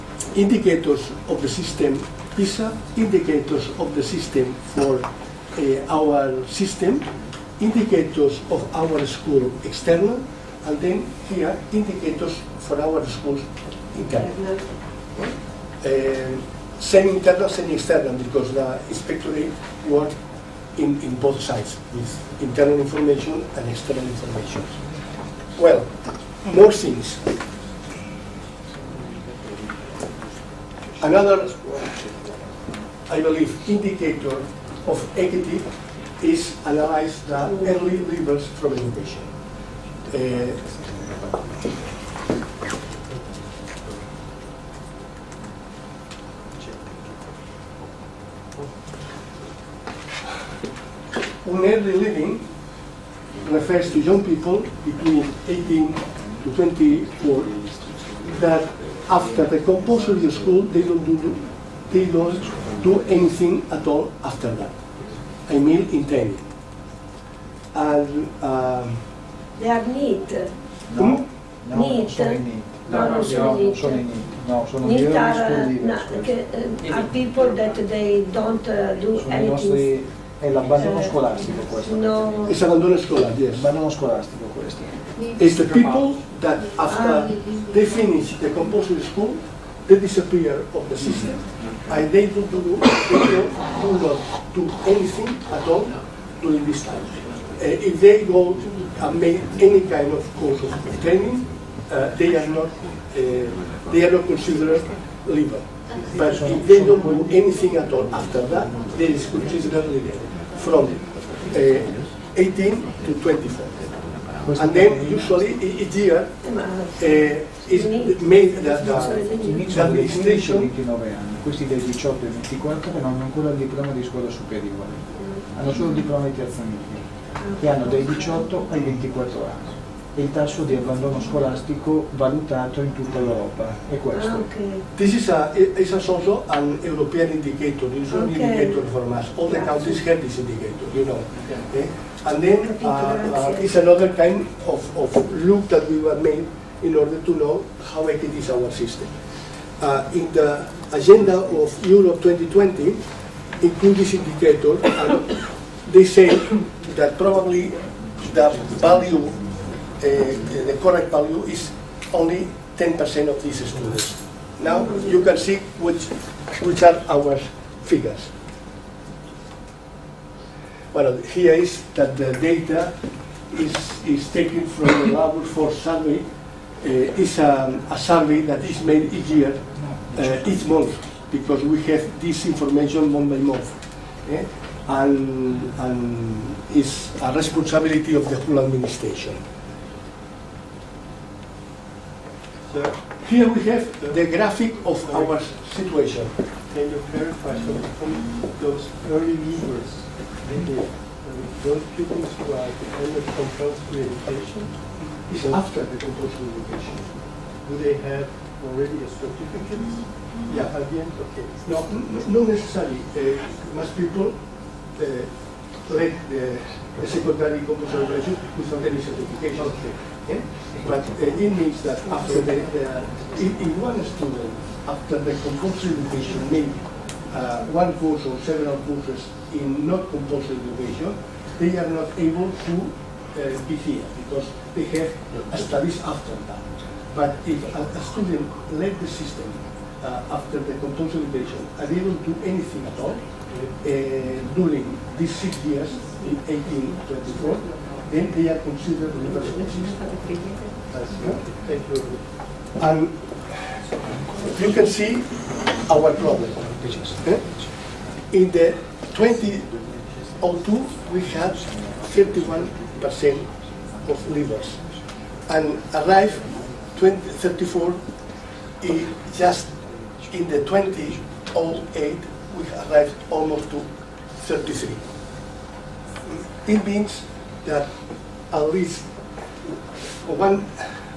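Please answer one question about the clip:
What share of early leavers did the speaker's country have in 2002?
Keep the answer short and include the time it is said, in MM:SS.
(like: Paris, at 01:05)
31%, at 04:22.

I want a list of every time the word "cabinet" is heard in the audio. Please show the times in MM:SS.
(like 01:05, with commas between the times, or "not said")
not said.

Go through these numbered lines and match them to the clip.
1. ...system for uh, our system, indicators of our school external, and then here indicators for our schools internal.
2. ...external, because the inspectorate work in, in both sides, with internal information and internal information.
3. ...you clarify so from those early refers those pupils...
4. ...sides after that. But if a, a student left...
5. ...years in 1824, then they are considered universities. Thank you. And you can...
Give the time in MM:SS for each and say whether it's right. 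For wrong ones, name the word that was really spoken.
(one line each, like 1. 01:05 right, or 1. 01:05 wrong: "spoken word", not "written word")
1. 00:04 right
2. 00:17 wrong: "external", not "internal"
3. 03:16 wrong: "movers", not "refers"
4. 03:55 wrong: "studies", not "sides"
5. 04:05 right.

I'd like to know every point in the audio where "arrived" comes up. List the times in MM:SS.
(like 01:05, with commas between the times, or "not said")
04:25, 04:32.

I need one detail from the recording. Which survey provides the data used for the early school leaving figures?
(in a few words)
Labor Force Survey.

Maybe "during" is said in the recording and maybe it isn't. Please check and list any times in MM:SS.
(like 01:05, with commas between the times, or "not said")
01:36, 04:04.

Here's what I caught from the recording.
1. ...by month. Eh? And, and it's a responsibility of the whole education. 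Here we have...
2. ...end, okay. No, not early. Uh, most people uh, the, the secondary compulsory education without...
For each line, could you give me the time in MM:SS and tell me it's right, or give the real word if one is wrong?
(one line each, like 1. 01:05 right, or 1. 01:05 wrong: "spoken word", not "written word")
1. 03:03 wrong: "administration", not "education"
2. 03:31 wrong: "necessarily", not "early".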